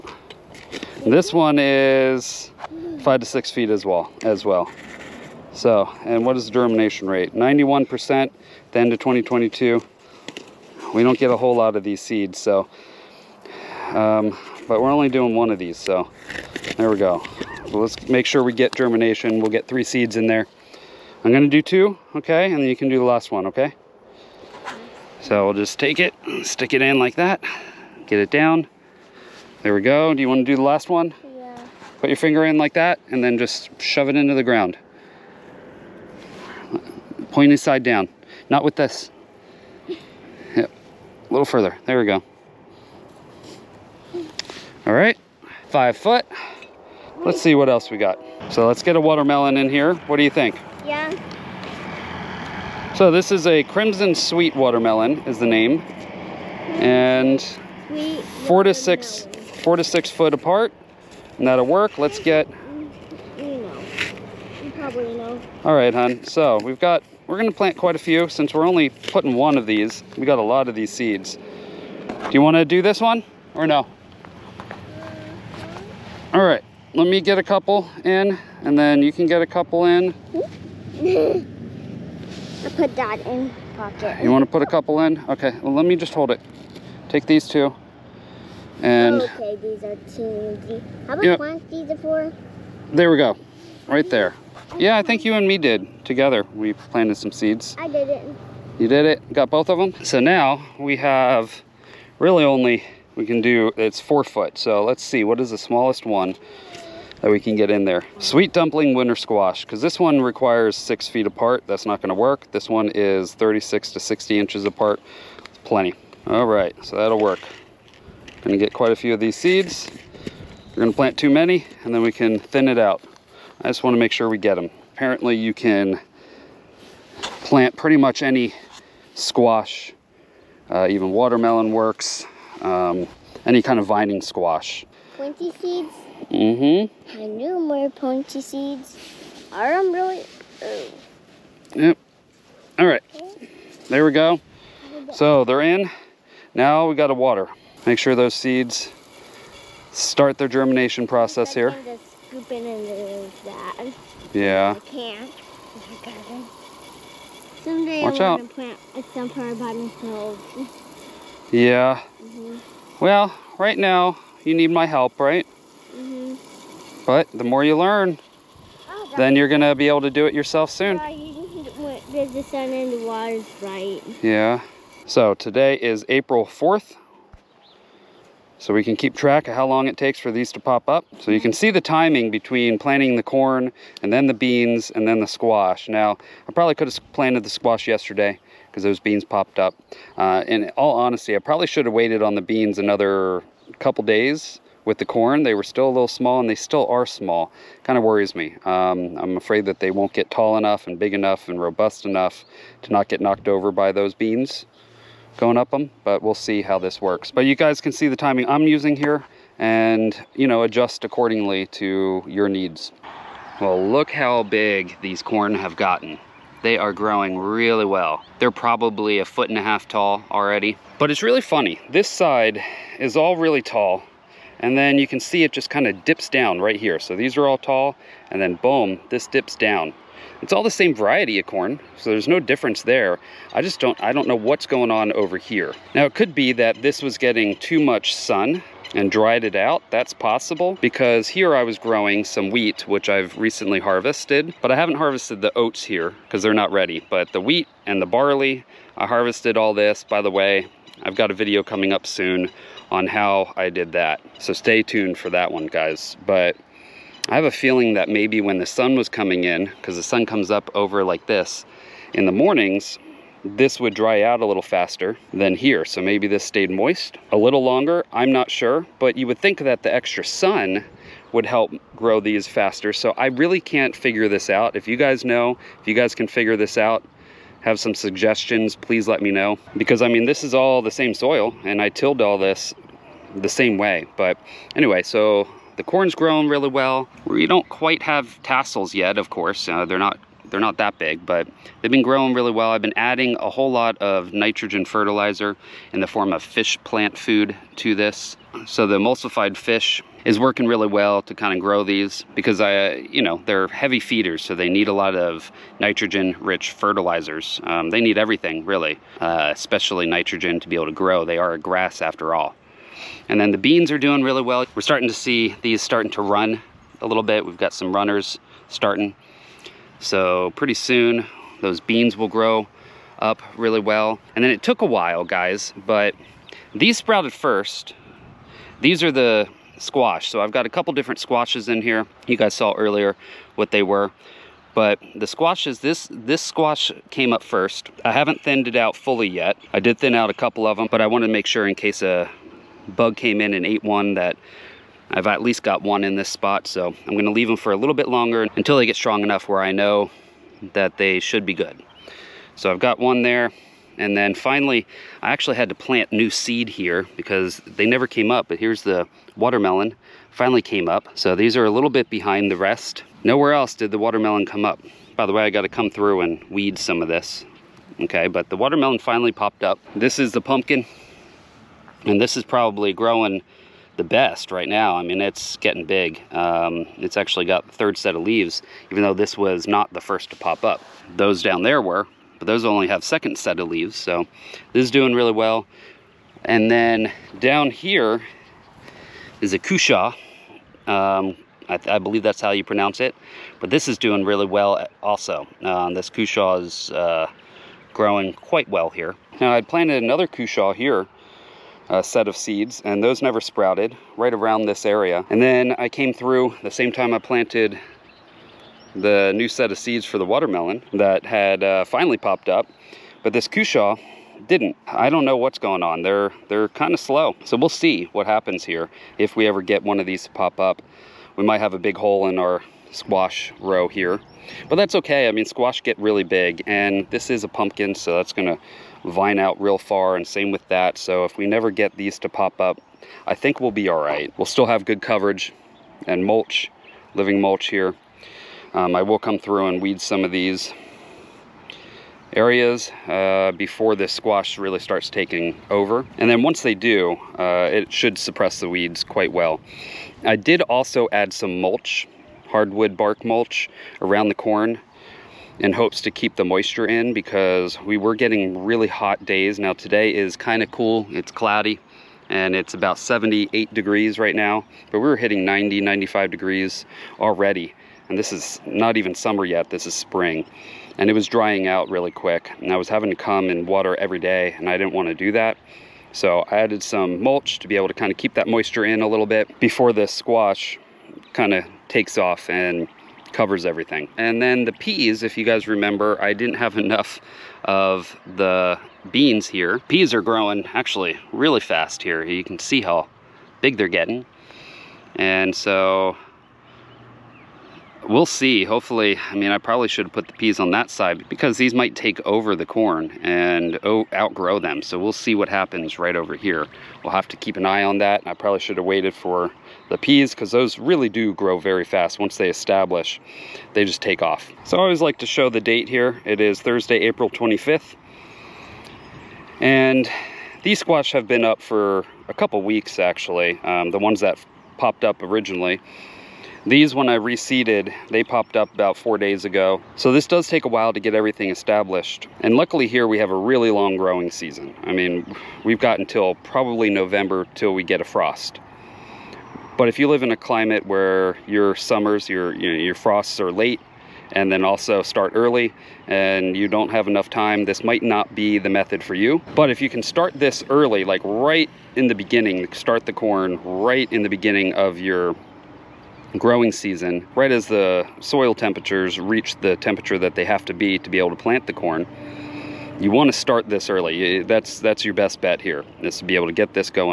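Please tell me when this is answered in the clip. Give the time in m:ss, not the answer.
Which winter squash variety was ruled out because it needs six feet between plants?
1:48.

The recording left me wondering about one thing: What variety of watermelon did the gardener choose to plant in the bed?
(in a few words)
Crimson Sweet.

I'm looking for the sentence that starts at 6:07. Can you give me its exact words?
Okay, but the watermelon finally popped up.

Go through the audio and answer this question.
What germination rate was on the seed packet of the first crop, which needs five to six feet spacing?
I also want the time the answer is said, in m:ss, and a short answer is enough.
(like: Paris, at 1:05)
91%, at 0:07.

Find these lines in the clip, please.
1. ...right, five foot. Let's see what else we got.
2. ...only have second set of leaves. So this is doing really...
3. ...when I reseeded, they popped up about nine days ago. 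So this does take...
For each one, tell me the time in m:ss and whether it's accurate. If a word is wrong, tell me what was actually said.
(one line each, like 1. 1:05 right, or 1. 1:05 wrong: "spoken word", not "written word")
1. 0:44 right
2. 6:22 right
3. 8:46 wrong: "four", not "nine".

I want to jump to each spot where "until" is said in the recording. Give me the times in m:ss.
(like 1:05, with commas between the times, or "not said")
5:48, 8:55.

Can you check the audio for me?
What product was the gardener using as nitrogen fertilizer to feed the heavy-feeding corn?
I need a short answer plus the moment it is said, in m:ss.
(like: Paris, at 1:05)
fish plant food, at 4:56.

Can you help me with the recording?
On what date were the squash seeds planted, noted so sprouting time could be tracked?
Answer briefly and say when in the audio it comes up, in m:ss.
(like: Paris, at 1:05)
April 4th, at 2:56.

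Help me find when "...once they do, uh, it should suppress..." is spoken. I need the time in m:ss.
7:26.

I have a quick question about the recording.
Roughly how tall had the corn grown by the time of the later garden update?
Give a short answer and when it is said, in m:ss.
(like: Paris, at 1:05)
a foot and a half, at 3:39.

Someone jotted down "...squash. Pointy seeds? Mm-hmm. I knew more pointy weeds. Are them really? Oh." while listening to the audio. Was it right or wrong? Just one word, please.
wrong.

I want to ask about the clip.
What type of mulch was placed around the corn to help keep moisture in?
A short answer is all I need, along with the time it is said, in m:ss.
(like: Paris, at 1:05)
hardwood bark mulch, at 7:32.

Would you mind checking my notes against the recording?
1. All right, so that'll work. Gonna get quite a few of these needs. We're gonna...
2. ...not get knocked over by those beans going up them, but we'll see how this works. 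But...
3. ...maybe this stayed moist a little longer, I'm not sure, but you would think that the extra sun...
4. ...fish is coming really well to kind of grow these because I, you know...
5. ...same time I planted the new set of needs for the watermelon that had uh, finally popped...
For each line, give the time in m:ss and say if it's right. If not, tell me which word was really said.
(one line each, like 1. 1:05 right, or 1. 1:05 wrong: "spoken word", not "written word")
1. 1:56 wrong: "seeds", not "needs"
2. 3:22 right
3. 4:26 right
4. 4:59 wrong: "working", not "coming"
5. 6:46 wrong: "seeds", not "needs".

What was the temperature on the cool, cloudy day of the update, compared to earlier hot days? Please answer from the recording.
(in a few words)
78 degrees.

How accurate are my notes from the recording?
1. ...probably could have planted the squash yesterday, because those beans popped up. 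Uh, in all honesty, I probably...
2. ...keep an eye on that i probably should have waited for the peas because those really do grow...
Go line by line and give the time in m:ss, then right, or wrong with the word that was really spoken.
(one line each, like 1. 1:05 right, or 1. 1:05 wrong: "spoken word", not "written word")
1. 3:06 right
2. 8:27 right.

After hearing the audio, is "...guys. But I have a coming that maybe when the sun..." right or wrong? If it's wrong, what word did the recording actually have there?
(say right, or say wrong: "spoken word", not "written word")
wrong: "feeling", not "coming".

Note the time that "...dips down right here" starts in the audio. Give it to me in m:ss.
3:46.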